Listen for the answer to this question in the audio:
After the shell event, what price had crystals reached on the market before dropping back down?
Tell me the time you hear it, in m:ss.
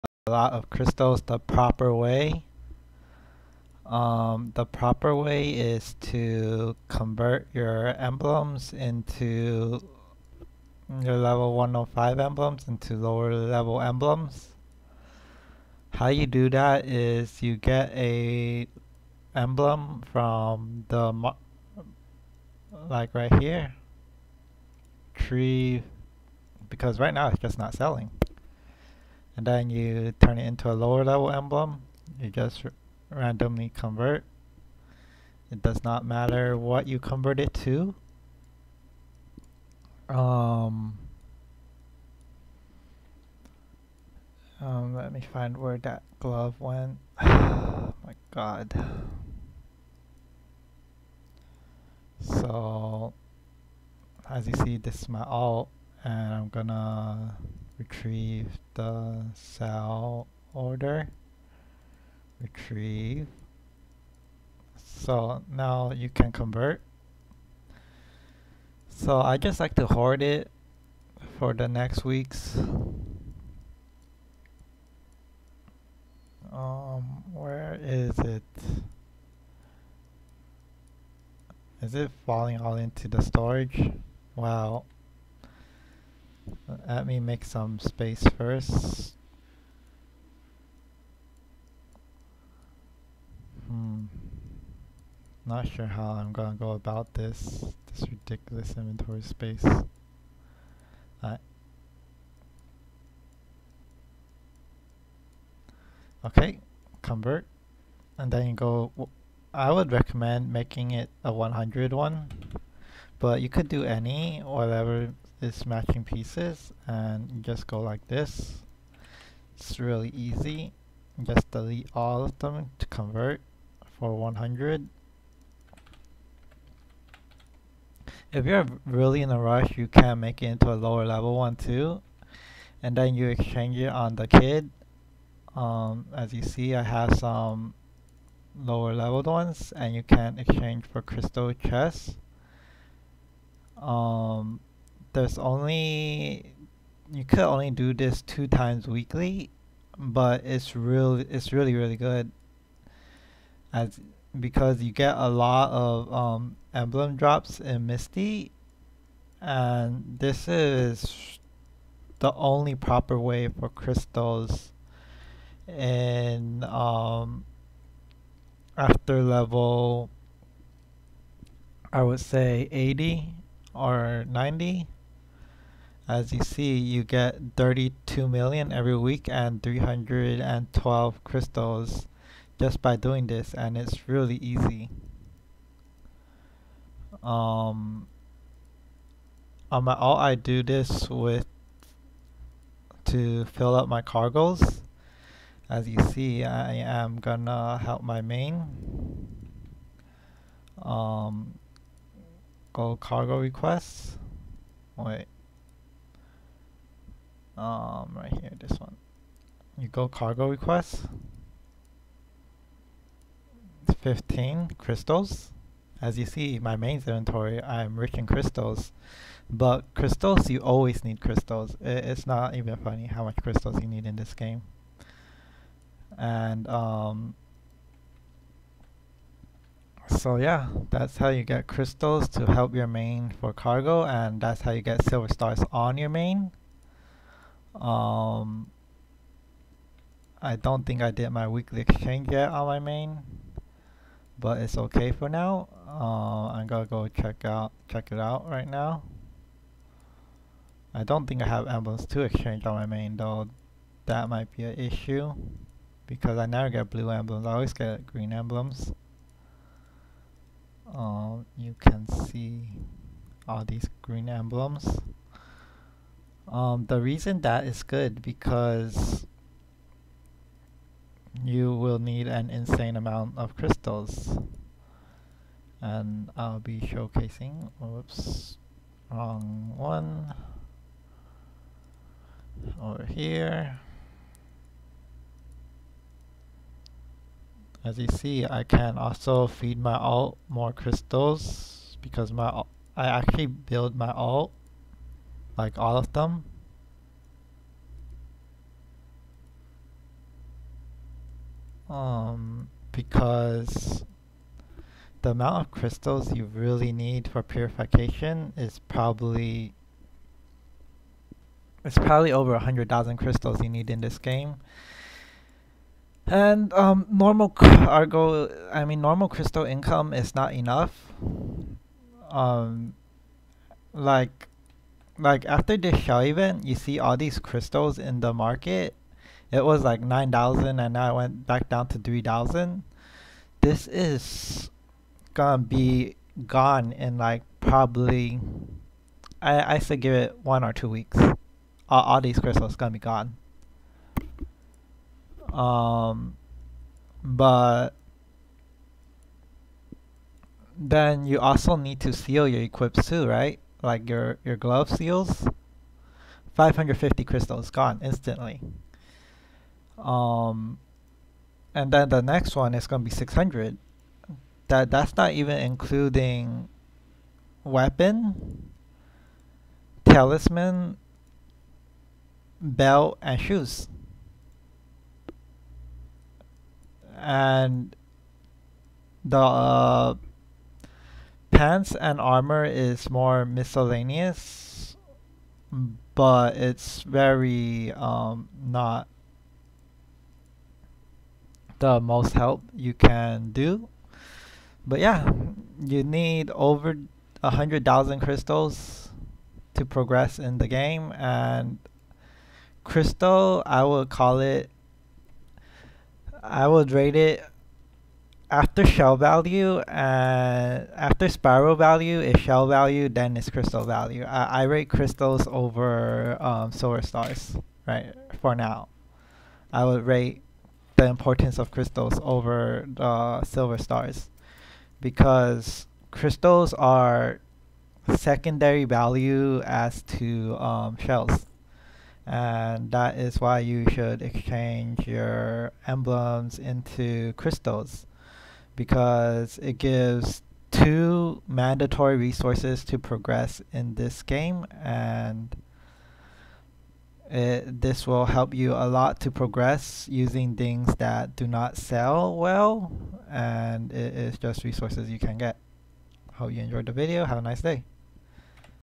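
5:30.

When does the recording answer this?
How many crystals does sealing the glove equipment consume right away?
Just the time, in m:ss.
5:56.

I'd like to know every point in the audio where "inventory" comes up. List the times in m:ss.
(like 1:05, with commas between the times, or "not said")
1:38, 3:36.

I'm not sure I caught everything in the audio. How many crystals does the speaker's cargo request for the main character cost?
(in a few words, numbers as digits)
15.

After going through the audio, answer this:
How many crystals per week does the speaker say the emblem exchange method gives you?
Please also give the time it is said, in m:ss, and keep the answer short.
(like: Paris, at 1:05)
312, at 2:59.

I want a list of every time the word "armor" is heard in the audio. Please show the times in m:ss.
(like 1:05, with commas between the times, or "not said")
6:22.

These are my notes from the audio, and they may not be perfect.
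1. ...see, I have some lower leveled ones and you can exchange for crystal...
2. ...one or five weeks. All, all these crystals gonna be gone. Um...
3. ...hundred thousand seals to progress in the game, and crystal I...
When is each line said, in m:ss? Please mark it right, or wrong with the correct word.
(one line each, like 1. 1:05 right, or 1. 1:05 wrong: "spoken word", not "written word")
1. 2:16 right
2. 5:40 wrong: "two", not "five"
3. 6:37 wrong: "crystals", not "seals".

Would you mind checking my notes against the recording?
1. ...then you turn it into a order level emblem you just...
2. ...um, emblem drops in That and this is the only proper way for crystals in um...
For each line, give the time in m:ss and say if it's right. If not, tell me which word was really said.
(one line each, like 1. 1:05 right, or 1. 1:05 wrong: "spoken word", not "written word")
1. 0:29 wrong: "lower", not "order"
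2. 2:36 wrong: "Misty", not "That".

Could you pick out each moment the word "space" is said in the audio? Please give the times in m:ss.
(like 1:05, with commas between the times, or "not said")
1:27, 1:39.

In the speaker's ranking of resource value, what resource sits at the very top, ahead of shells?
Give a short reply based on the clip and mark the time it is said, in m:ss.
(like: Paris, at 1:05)
Spiral, at 6:51.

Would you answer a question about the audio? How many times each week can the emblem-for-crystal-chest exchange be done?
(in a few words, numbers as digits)
2.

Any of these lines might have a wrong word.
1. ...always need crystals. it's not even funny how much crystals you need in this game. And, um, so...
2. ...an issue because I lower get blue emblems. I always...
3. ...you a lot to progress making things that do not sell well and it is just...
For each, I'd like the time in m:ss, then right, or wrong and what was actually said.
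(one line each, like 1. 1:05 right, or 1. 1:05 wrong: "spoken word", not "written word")
1. 3:40 right
2. 4:14 wrong: "never", not "lower"
3. 7:28 wrong: "using", not "making".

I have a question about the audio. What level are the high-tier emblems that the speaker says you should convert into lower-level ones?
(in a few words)
105.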